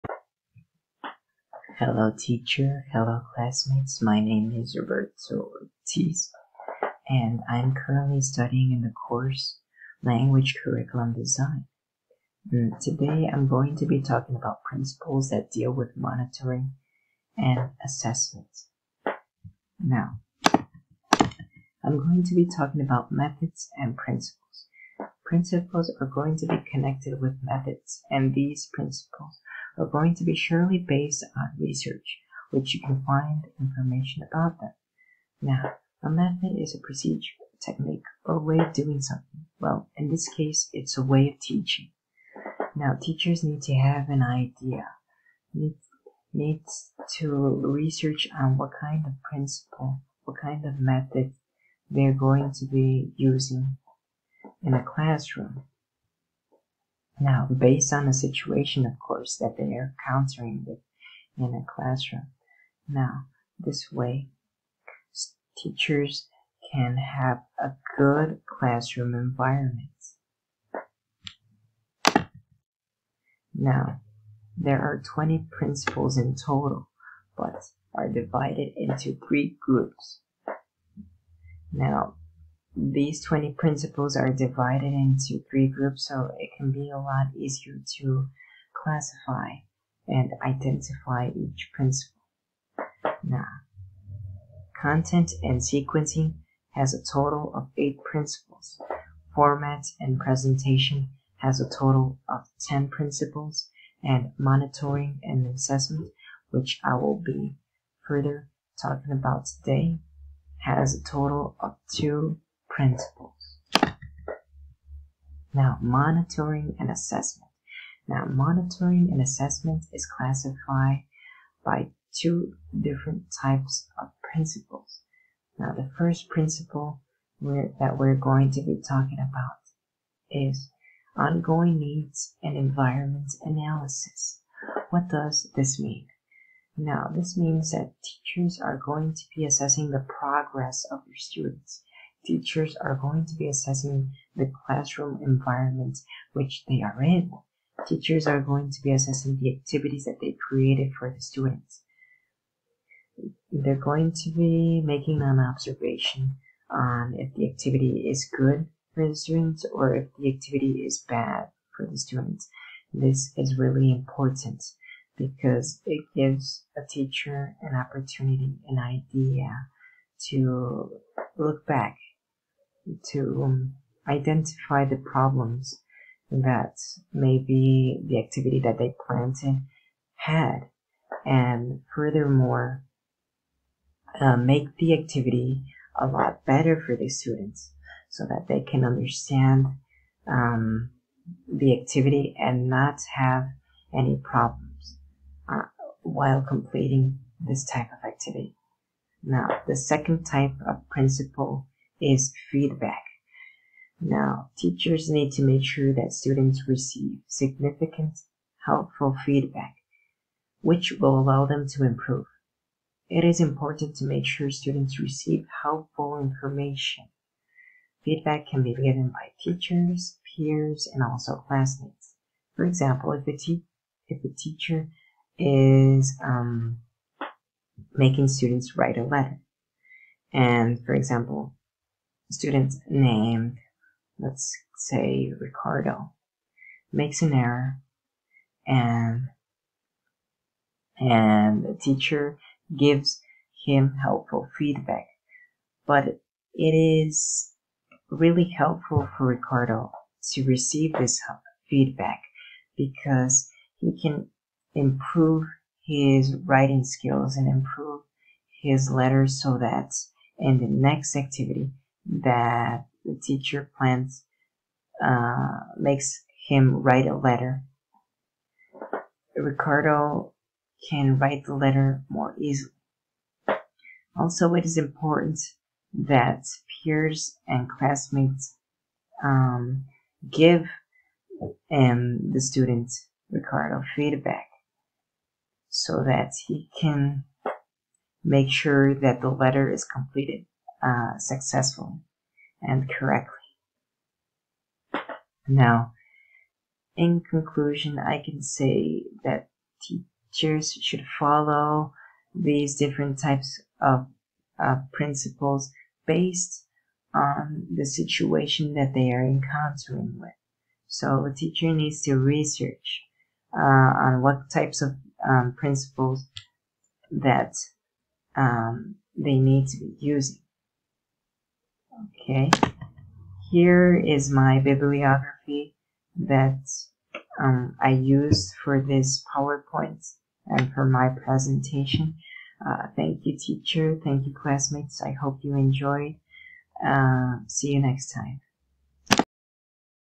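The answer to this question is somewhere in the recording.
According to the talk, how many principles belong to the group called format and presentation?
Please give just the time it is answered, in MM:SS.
01:42.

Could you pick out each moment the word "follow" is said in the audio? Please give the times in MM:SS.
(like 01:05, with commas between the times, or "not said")
05:01.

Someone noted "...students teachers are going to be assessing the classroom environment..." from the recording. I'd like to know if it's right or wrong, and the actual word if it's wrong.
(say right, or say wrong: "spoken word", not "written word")
right.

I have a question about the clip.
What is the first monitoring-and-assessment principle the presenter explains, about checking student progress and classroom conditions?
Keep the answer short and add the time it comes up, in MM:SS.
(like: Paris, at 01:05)
Ongoing needs and environment analysis, at 02:11.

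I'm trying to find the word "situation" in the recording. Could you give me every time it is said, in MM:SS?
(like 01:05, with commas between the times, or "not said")
00:58, 05:07.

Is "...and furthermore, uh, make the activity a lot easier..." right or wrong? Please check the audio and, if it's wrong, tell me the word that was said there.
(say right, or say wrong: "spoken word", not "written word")
wrong: "better", not "easier".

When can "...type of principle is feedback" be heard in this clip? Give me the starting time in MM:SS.
03:20.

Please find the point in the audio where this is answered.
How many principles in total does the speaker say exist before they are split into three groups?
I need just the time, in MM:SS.
01:15.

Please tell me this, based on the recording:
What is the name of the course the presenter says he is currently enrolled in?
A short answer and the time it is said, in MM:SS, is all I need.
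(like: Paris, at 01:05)
Language Curriculum Design, at 00:10.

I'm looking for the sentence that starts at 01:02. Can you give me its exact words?
Now, this way, teachers can have a good classroom environment.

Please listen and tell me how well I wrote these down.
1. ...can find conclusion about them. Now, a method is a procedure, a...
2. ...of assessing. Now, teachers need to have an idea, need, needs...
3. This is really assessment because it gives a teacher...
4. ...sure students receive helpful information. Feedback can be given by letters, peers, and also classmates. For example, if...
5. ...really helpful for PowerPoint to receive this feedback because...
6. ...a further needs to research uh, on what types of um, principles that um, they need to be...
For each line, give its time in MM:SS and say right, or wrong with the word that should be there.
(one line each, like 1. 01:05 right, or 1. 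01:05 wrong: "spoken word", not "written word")
1. 00:32 wrong: "information", not "conclusion"
2. 00:41 wrong: "teaching", not "assessing"
3. 02:42 wrong: "important", not "assessment"
4. 03:34 wrong: "teachers", not "letters"
5. 04:08 wrong: "Ricardo", not "PowerPoint"
6. 05:11 wrong: "teacher", not "further".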